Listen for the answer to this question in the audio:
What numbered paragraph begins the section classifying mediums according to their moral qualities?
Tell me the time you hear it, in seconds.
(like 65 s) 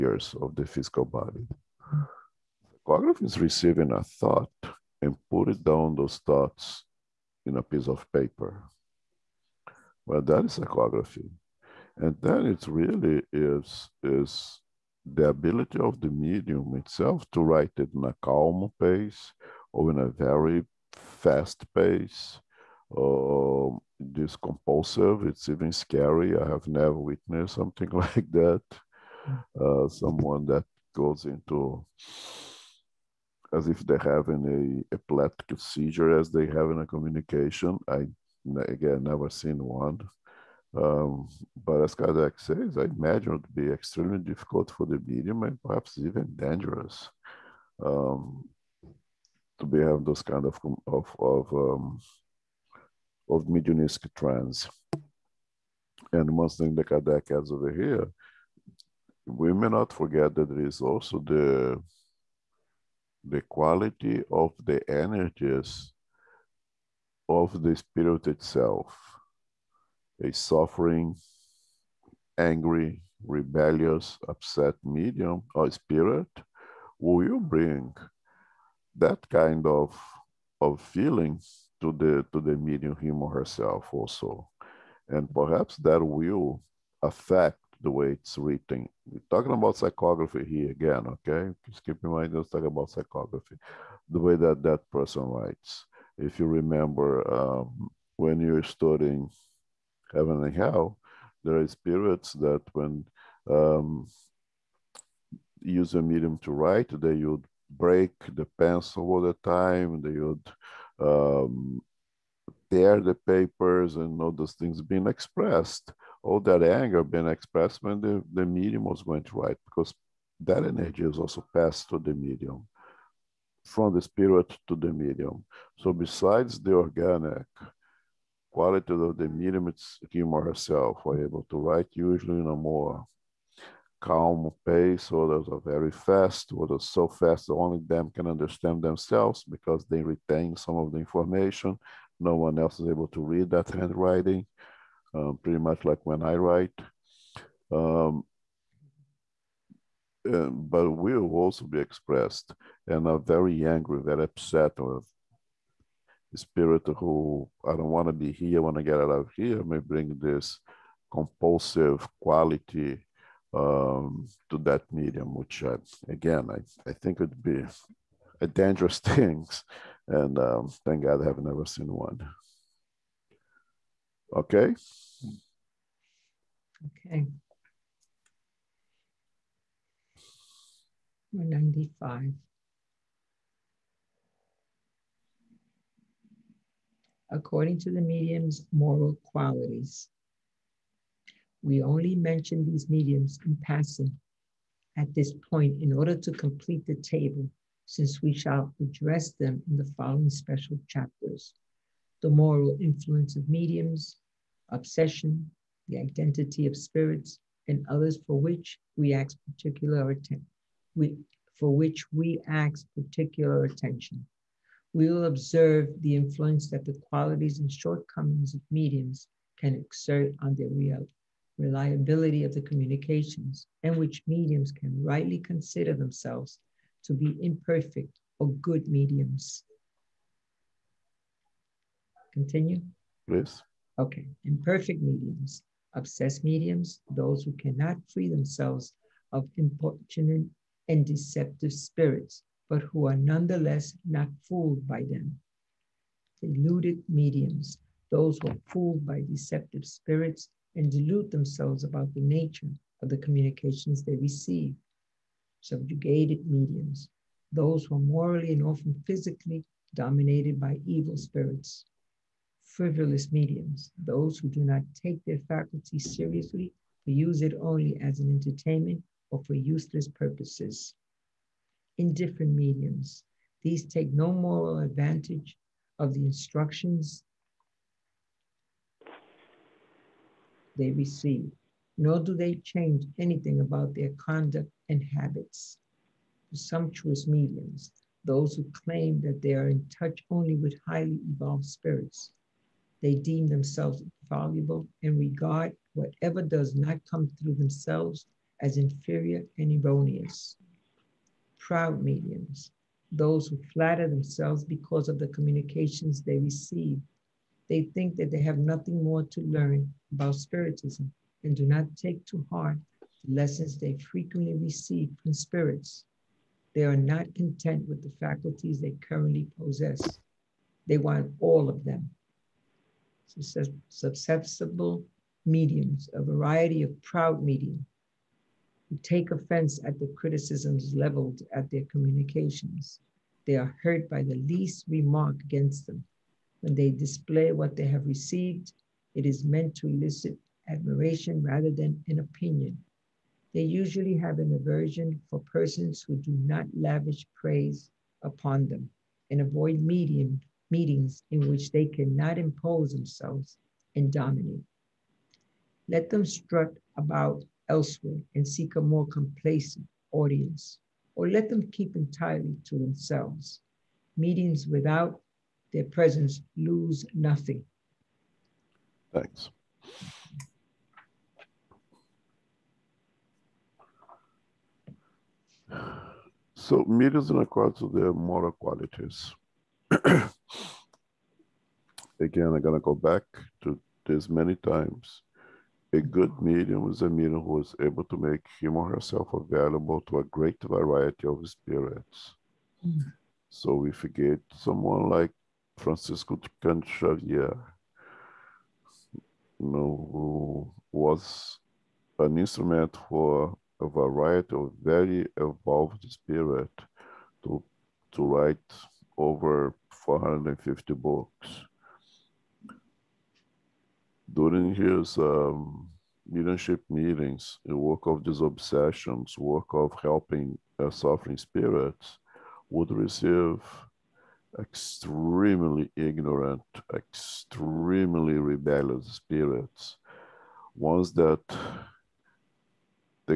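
181 s.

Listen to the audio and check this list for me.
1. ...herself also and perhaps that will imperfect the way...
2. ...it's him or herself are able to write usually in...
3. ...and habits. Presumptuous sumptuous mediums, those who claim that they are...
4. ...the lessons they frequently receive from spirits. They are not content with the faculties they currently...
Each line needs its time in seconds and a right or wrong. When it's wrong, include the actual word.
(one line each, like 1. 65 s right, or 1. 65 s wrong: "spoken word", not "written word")
1. 83 s wrong: "affect", not "imperfect"
2. 129 s right
3. 284 s right
4. 313 s right.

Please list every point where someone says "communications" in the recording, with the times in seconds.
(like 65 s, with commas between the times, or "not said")
36 s, 222 s, 253 s, 305 s, 331 s.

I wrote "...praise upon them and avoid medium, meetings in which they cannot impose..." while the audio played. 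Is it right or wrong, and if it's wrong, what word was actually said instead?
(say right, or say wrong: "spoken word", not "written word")
right.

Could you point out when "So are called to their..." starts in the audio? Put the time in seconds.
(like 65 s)
376 s.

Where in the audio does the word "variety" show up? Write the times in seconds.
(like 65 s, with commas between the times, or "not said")
326 s, 390 s, 403 s.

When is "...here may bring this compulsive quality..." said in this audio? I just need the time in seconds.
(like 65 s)
159 s.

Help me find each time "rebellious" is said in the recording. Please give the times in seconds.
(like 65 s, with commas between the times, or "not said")
73 s, 428 s.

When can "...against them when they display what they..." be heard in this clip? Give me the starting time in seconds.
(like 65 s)
335 s.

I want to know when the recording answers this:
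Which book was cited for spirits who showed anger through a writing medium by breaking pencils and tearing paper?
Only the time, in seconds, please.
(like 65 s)
100 s.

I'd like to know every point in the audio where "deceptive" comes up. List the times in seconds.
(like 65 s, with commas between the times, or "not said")
241 s, 249 s.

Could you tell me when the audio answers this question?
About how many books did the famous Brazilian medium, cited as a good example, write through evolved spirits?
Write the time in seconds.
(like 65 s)
409 s.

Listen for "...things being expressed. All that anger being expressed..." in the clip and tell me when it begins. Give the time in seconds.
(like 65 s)
114 s.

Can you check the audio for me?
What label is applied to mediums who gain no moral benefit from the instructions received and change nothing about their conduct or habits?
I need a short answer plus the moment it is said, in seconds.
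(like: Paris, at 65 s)
Indifferent mediums, at 271 s.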